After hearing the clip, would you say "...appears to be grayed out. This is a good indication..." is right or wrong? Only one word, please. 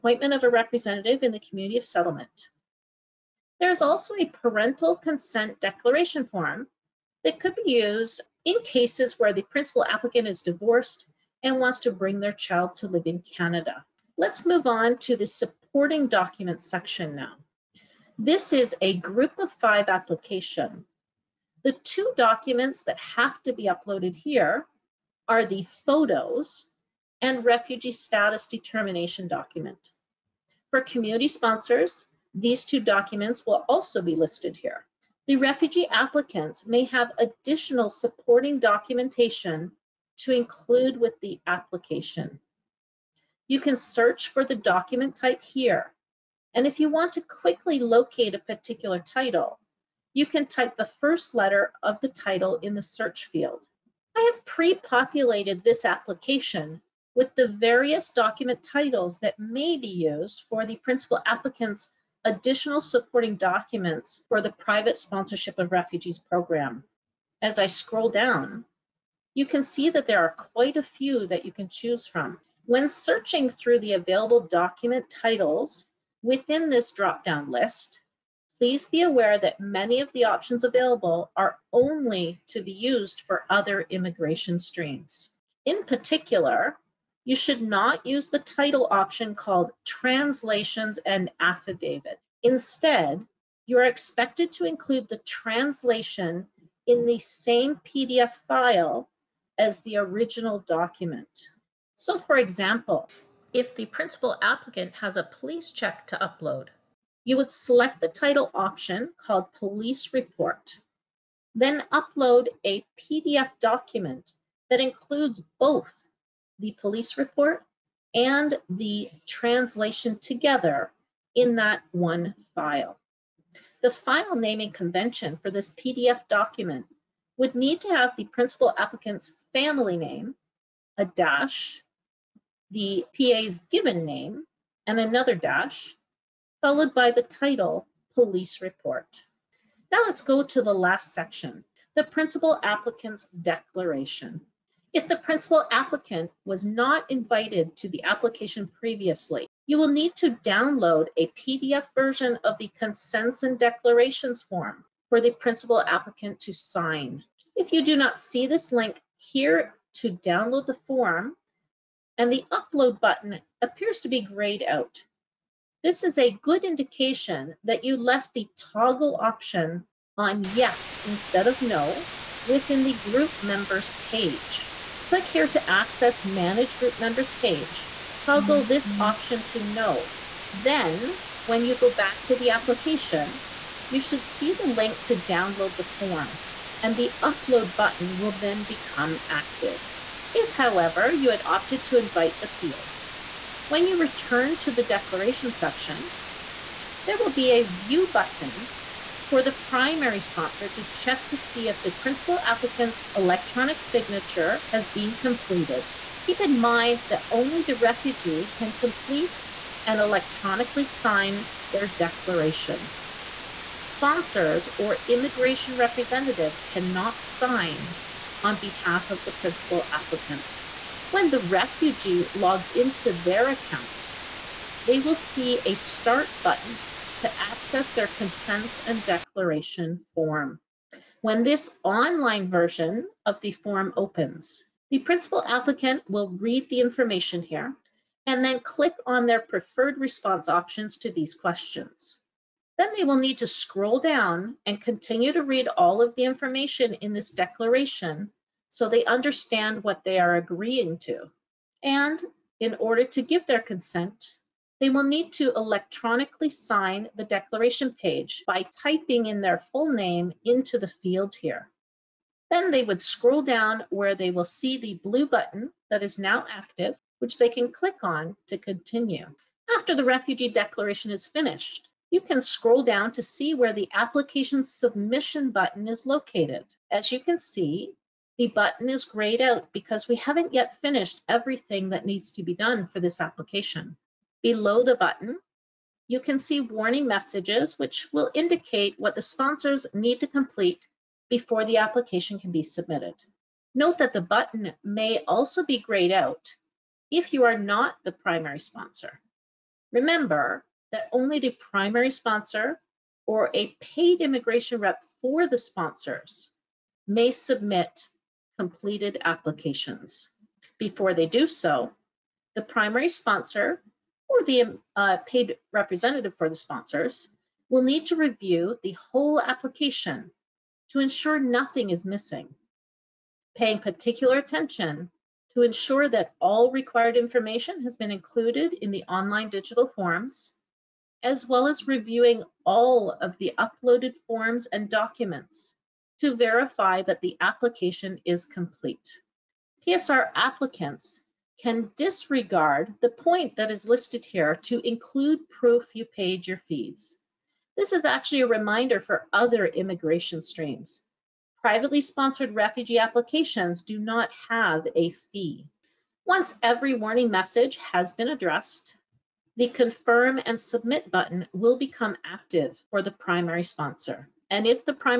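right.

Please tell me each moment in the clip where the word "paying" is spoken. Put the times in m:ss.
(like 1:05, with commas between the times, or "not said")
5:23.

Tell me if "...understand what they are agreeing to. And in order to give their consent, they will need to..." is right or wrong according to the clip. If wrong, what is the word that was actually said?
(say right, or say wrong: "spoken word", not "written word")
right.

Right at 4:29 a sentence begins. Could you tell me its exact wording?
After the refugee declaration is finished, you can scroll down to see where the application submission button is located.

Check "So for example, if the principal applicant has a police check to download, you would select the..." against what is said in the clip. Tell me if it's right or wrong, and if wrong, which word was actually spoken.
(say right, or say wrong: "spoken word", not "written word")
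wrong: "upload", not "download".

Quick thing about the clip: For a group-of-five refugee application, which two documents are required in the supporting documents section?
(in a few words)
Photos and refugee status determination document.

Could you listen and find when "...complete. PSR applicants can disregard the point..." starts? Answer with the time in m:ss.
5:38.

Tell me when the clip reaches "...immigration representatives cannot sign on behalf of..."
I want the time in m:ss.
3:35.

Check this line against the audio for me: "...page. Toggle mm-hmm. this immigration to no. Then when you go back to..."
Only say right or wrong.
wrong.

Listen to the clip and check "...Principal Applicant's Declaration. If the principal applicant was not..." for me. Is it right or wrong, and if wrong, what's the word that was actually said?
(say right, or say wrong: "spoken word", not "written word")
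right.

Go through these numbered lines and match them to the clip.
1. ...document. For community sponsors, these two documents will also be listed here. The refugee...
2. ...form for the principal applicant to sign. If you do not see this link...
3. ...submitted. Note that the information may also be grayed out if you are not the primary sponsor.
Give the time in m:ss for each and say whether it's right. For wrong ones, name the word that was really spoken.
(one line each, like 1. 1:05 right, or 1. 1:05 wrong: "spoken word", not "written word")
1. 0:29 right
2. 2:34 right
3. 4:52 wrong: "button", not "information".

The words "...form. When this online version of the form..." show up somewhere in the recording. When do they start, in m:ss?
3:50.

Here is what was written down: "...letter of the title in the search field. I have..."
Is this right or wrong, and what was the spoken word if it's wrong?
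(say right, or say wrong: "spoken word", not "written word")
right.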